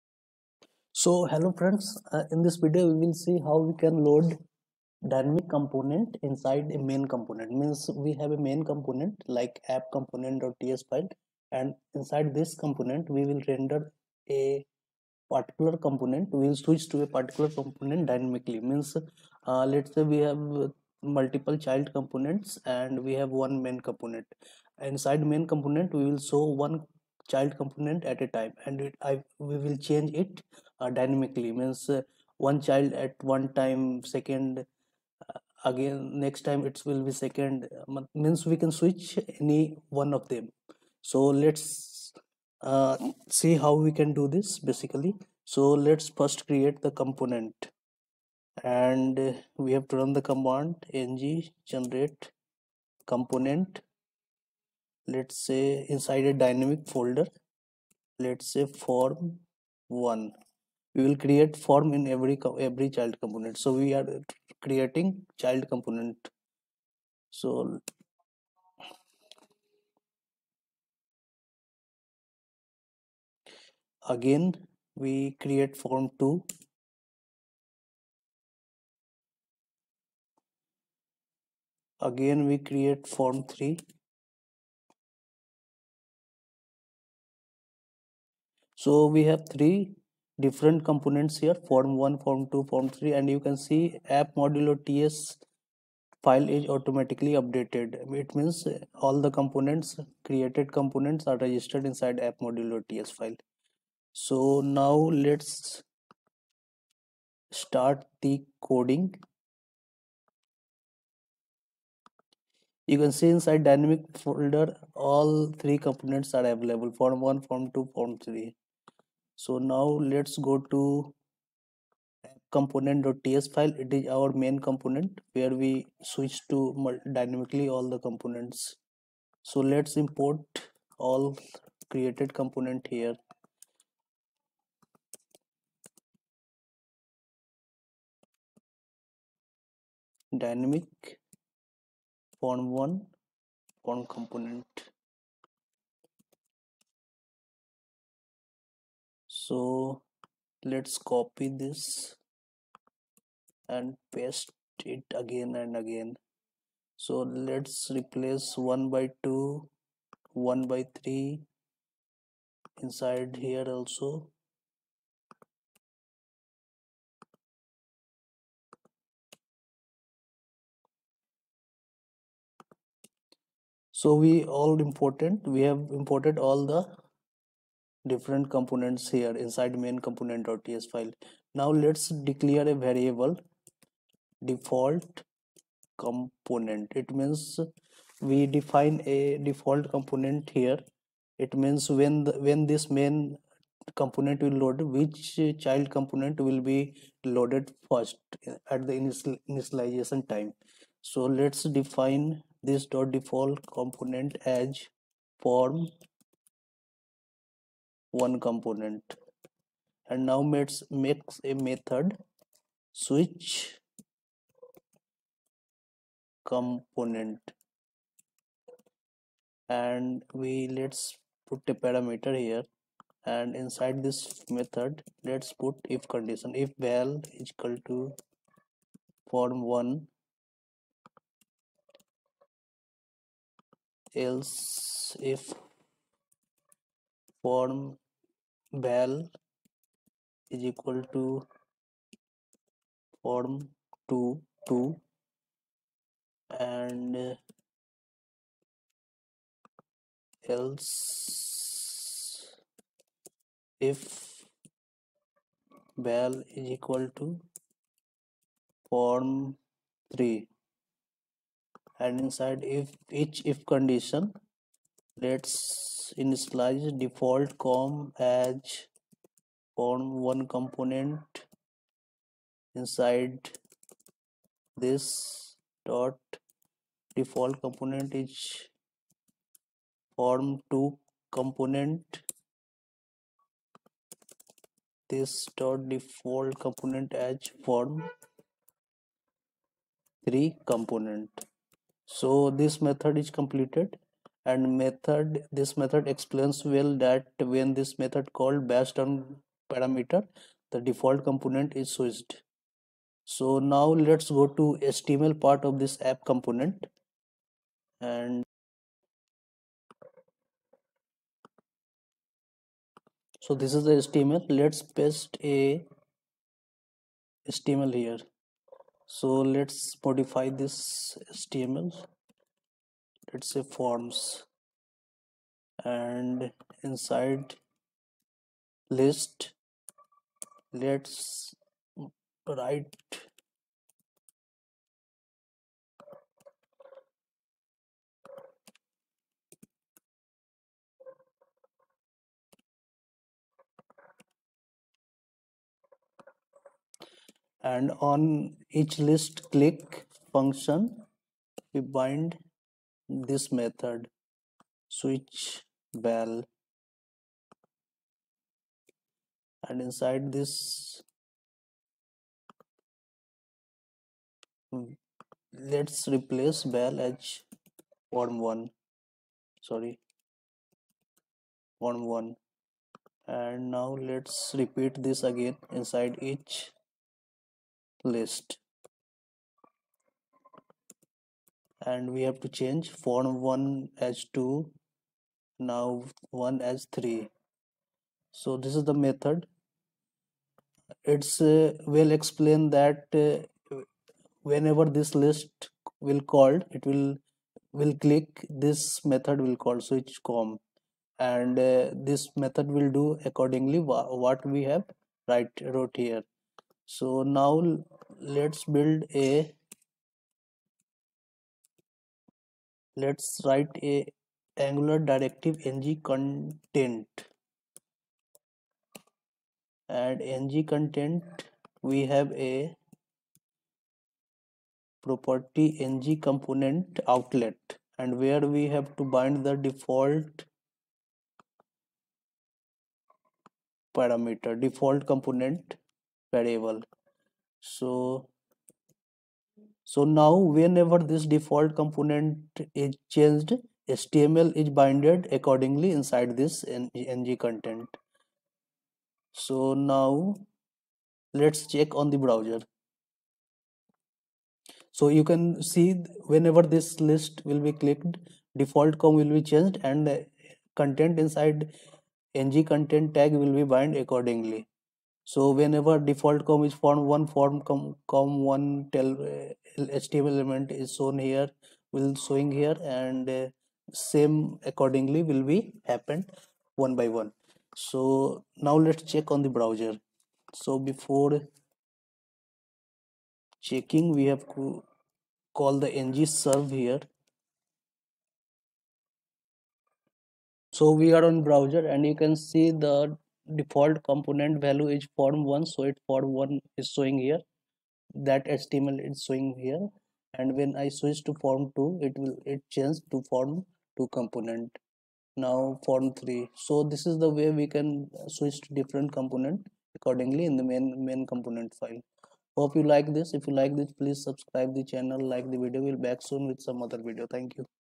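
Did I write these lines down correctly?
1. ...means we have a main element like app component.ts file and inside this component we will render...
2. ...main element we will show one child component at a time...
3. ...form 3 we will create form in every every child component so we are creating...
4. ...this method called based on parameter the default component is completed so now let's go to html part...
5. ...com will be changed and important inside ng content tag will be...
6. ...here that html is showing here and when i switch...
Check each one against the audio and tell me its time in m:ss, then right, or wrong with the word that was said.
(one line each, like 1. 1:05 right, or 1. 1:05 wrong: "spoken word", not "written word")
1. 0:07 wrong: "component", not "element"
2. 0:25 wrong: "component", not "element"
3. 0:58 wrong: "1", not "3"
4. 4:57 wrong: "switched", not "completed"
5. 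7:38 wrong: "content", not "important"
6. 8:17 right.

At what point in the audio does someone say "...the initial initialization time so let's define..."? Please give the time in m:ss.
3:18.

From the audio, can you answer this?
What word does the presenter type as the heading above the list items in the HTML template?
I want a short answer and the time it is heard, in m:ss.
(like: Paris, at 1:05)
forms, at 5:23.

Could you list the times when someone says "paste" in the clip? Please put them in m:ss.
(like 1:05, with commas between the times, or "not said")
2:34, 5:15.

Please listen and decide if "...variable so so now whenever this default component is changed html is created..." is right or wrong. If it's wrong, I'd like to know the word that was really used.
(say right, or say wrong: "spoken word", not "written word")
wrong: "binded", not "created".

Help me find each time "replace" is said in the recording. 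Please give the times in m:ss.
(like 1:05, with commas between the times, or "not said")
2:37, 6:06.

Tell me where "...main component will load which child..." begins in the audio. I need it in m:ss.
3:12.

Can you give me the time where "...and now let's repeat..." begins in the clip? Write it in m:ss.
6:13.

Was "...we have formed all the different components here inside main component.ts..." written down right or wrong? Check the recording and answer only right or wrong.
wrong.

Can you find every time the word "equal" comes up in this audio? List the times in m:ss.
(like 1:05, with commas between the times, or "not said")
3:47, 4:00, 4:16.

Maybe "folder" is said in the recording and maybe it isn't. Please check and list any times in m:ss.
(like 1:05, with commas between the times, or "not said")
0:56, 1:54.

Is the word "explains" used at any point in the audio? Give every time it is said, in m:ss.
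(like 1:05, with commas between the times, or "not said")
4:56, 6:32.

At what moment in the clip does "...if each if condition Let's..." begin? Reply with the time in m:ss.
4:22.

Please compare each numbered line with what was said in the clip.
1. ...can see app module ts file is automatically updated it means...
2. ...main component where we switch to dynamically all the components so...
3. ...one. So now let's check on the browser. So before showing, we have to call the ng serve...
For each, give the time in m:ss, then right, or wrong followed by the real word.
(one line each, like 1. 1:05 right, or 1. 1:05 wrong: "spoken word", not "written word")
1. 1:33 right
2. 2:04 right
3. 7:57 wrong: "checking", not "showing".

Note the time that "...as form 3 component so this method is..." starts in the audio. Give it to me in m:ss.
4:47.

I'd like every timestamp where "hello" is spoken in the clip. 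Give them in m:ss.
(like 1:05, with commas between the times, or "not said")
0:01.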